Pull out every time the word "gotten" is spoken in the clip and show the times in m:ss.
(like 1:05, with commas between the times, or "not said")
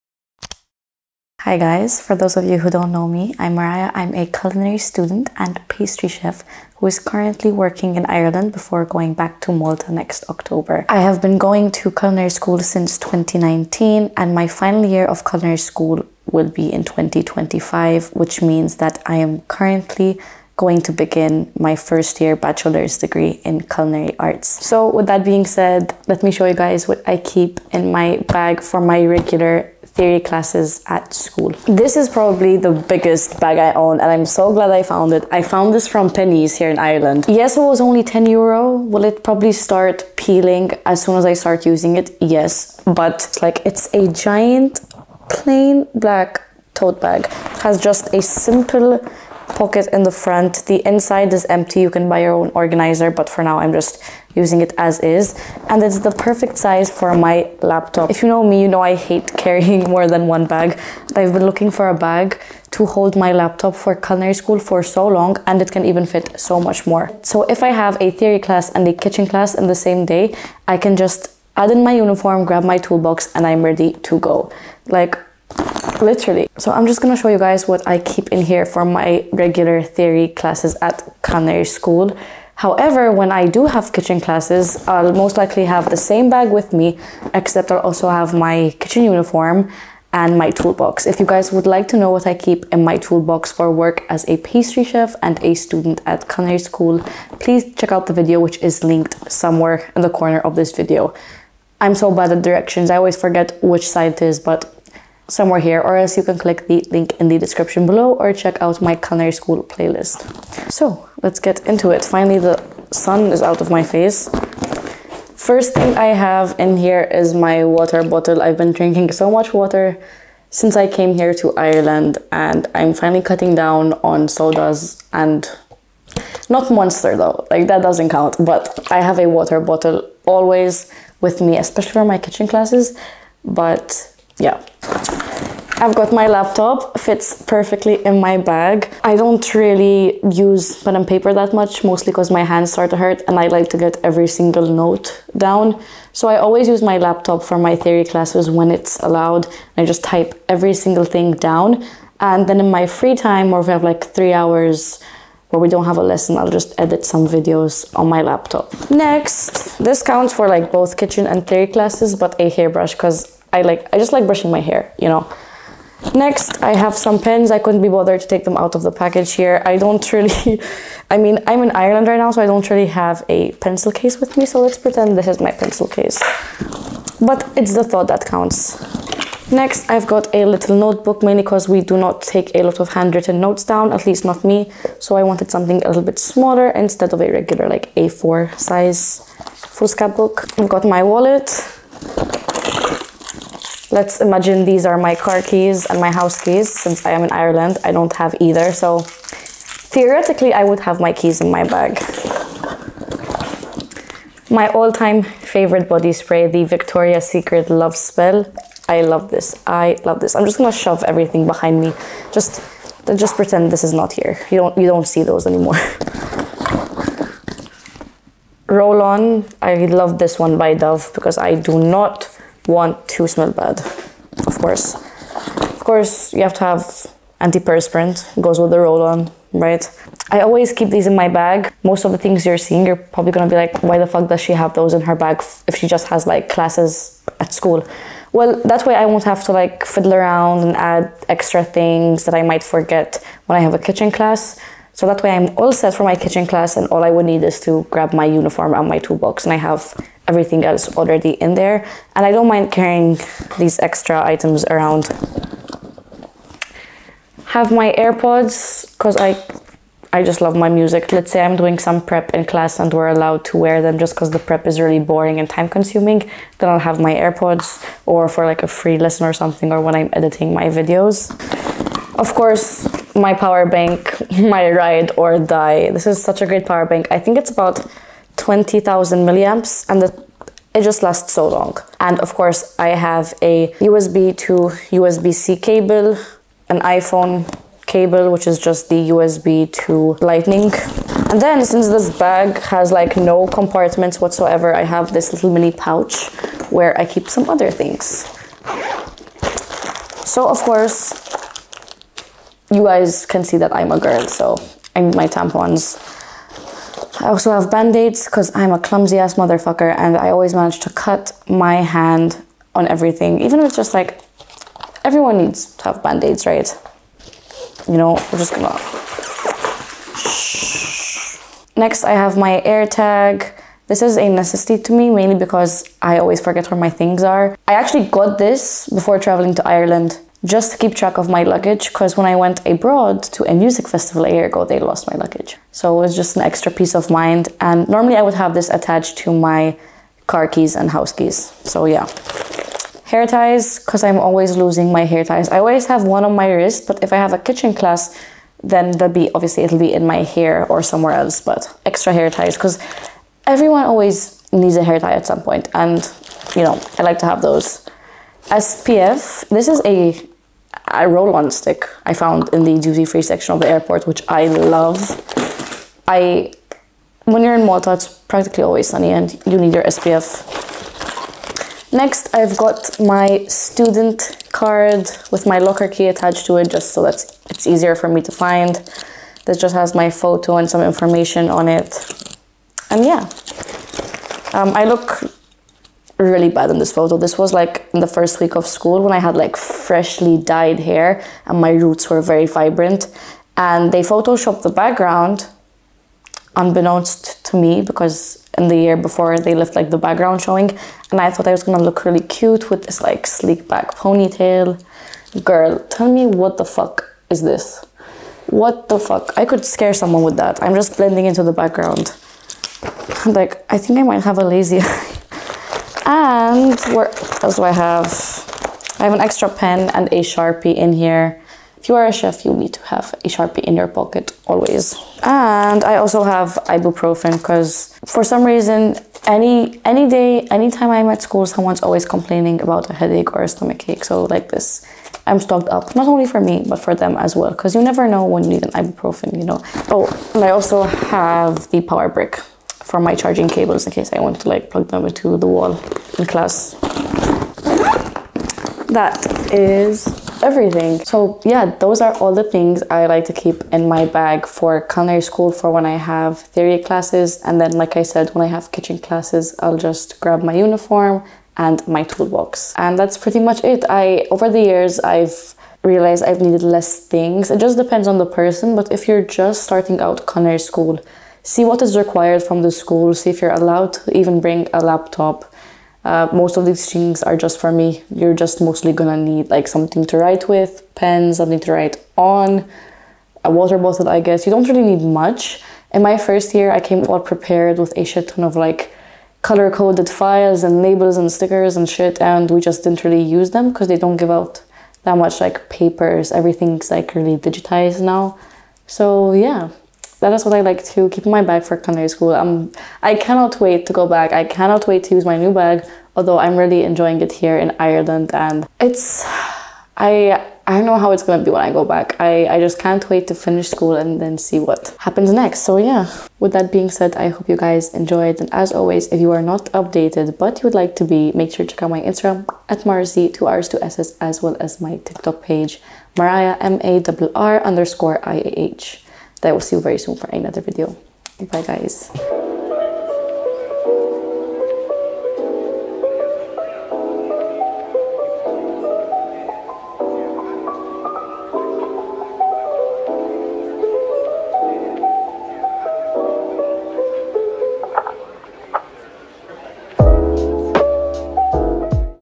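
not said.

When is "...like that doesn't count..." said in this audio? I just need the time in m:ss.
2:07.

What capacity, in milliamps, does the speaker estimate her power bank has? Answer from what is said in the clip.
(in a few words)
20,000.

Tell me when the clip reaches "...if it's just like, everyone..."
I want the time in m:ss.
5:13.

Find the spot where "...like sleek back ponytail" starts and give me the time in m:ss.
6:43.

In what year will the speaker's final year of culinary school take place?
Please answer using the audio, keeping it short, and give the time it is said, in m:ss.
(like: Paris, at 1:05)
2025, at 0:16.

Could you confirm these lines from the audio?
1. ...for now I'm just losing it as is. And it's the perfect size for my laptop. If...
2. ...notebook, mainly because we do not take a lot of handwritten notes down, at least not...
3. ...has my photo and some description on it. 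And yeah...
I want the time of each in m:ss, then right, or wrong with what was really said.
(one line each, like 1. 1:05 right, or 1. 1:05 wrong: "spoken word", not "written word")
1. 0:53 wrong: "using", not "losing"
2. 3:00 right
3. 6:19 wrong: "information", not "description".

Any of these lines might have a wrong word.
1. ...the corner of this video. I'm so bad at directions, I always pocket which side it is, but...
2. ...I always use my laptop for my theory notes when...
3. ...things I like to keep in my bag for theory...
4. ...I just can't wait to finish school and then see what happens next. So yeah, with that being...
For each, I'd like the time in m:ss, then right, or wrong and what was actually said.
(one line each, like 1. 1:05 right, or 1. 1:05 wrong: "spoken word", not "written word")
1. 1:40 wrong: "forget", not "pocket"
2. 2:26 wrong: "classes", not "notes"
3. 7:32 wrong: "culinary", not "theory"
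4. 8:32 right.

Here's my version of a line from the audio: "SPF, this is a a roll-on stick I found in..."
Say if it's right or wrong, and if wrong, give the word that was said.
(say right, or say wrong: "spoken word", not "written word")
right.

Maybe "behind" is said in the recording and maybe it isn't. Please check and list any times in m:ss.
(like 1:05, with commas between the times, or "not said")
3:31.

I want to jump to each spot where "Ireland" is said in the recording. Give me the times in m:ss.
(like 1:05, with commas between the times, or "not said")
0:08, 0:36, 2:01, 2:51, 3:17, 5:29, 8:27.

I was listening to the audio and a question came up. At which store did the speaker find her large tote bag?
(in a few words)
Penneys.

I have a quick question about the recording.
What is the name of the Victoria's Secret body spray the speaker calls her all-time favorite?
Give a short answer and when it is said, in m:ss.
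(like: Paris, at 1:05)
Love Spell, at 3:27.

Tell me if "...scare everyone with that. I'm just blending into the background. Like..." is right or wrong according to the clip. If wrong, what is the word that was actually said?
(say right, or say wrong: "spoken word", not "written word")
wrong: "someone", not "everyone".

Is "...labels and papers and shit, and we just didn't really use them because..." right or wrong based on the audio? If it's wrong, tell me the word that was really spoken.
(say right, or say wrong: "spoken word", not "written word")
wrong: "stickers", not "papers".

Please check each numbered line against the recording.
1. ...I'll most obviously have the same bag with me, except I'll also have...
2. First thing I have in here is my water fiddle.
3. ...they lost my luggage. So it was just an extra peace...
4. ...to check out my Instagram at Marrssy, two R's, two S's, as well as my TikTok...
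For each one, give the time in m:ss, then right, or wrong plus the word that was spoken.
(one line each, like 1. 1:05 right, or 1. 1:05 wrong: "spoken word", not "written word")
1. 1:24 wrong: "likely", not "obviously"
2. 1:55 wrong: "bottle", not "fiddle"
3. 5:34 right
4. 8:41 right.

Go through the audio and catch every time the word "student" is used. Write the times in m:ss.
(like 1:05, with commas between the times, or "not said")
0:04, 1:35, 6:13.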